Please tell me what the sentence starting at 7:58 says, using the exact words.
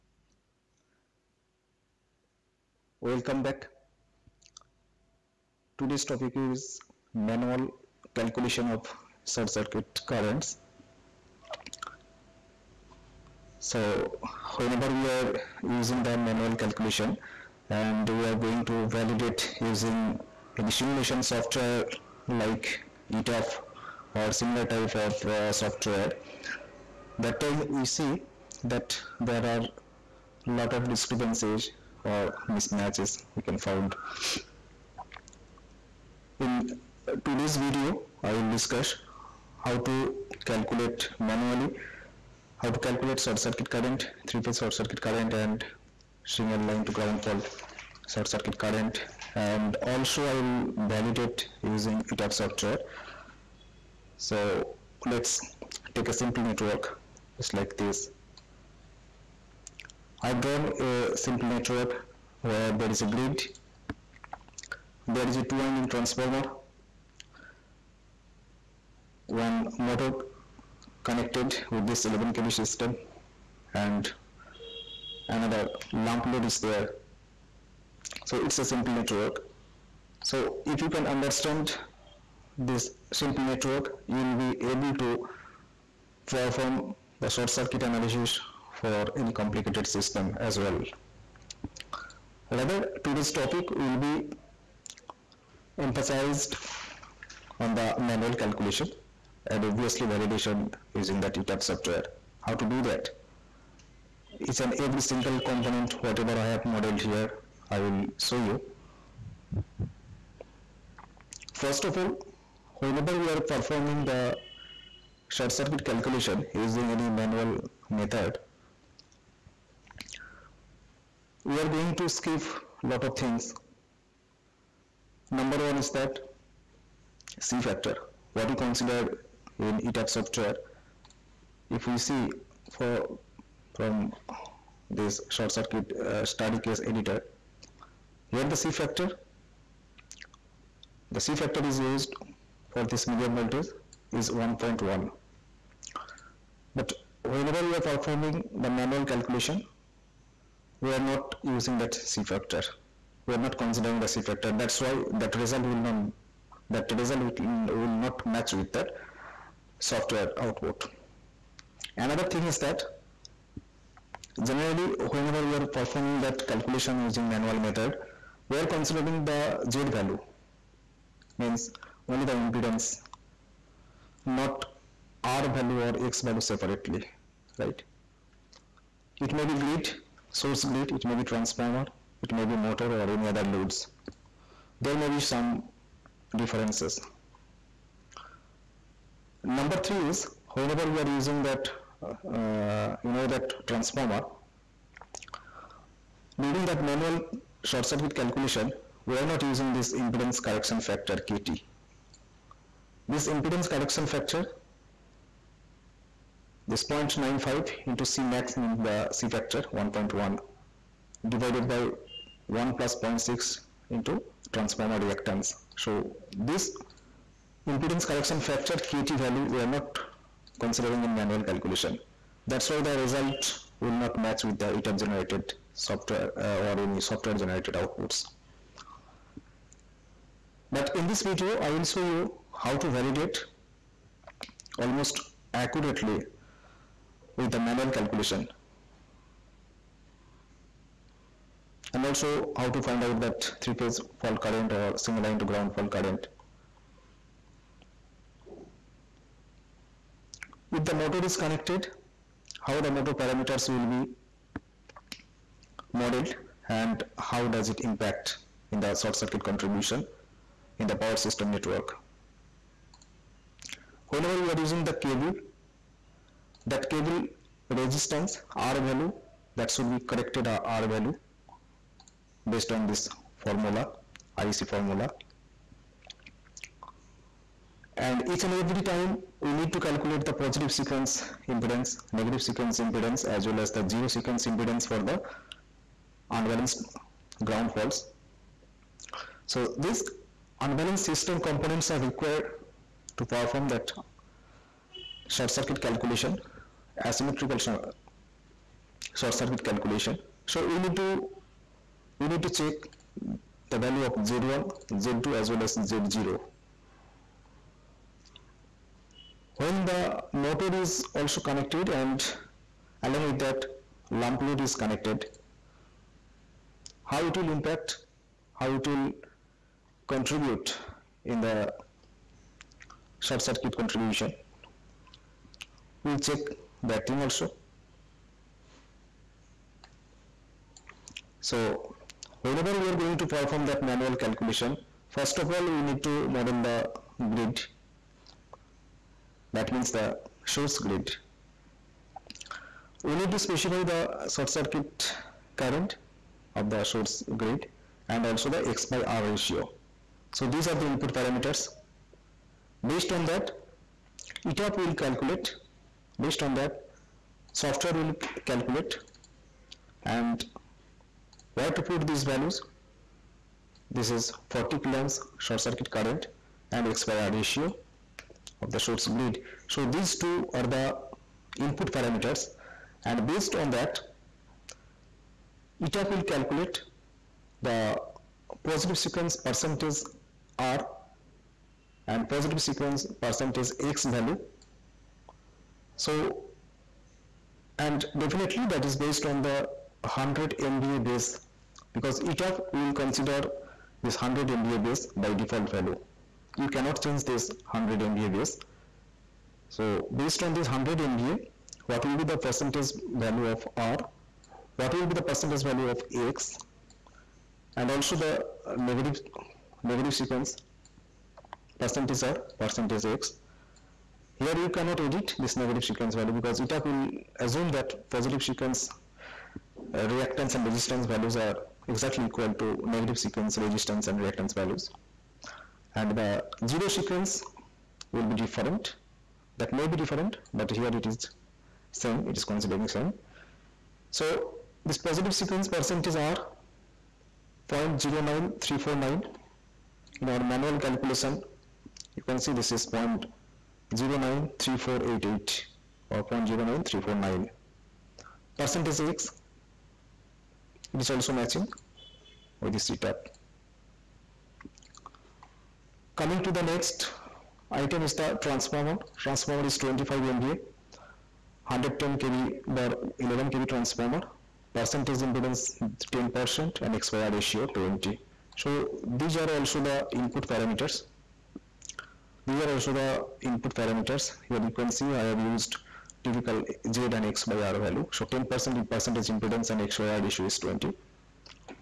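So 10% in percentage impedance and X by R issue is 20.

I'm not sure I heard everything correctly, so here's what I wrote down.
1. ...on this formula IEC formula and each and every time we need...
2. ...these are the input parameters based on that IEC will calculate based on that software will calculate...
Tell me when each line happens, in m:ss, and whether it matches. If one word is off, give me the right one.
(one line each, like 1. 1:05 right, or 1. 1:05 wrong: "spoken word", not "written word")
1. 4:32 right
2. 5:50 wrong: "ETAP", not "IEC".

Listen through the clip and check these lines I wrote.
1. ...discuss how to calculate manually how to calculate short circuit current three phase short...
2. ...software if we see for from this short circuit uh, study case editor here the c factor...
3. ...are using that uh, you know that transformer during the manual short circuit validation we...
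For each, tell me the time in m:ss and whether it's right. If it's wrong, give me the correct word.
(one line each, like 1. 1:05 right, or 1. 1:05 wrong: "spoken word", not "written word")
1. 0:38 right
2. 2:10 right
3. 3:10 wrong: "calculation", not "validation".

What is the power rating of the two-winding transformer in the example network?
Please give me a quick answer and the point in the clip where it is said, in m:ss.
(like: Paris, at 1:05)
25 MVA, at 7:39.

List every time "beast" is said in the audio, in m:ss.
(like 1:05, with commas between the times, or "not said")
not said.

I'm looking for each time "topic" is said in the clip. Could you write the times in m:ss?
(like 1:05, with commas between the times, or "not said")
0:06, 1:33.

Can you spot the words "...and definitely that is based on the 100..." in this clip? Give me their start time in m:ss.
6:27.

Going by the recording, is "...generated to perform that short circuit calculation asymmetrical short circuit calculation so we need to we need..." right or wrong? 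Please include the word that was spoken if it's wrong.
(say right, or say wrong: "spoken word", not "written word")
wrong: "required", not "generated".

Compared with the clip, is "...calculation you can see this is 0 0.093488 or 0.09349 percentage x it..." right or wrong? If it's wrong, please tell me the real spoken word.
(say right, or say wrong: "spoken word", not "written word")
right.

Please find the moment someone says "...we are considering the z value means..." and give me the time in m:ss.
2:48.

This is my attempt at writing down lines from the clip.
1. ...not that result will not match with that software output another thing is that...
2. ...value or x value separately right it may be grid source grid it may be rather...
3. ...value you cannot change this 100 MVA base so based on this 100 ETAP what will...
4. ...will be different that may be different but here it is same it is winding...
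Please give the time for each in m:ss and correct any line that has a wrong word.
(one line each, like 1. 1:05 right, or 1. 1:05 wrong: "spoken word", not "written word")
1. 2:35 right
2. 2:55 wrong: "transformer", not "rather"
3. 6:35 wrong: "MVA", not "ETAP"
4. 7:08 wrong: "considering", not "winding".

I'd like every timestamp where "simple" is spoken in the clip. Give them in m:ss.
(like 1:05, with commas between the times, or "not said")
0:56, 1:01, 1:18, 1:23.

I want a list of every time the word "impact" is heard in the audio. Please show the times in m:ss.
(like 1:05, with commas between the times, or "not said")
4:17, 5:17.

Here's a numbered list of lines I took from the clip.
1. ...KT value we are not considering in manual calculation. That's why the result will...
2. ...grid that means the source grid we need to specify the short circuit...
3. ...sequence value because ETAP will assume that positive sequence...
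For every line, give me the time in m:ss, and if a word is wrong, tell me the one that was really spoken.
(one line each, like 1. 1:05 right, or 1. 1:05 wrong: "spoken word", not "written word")
1. 3:38 right
2. 5:37 right
3. 6:55 right.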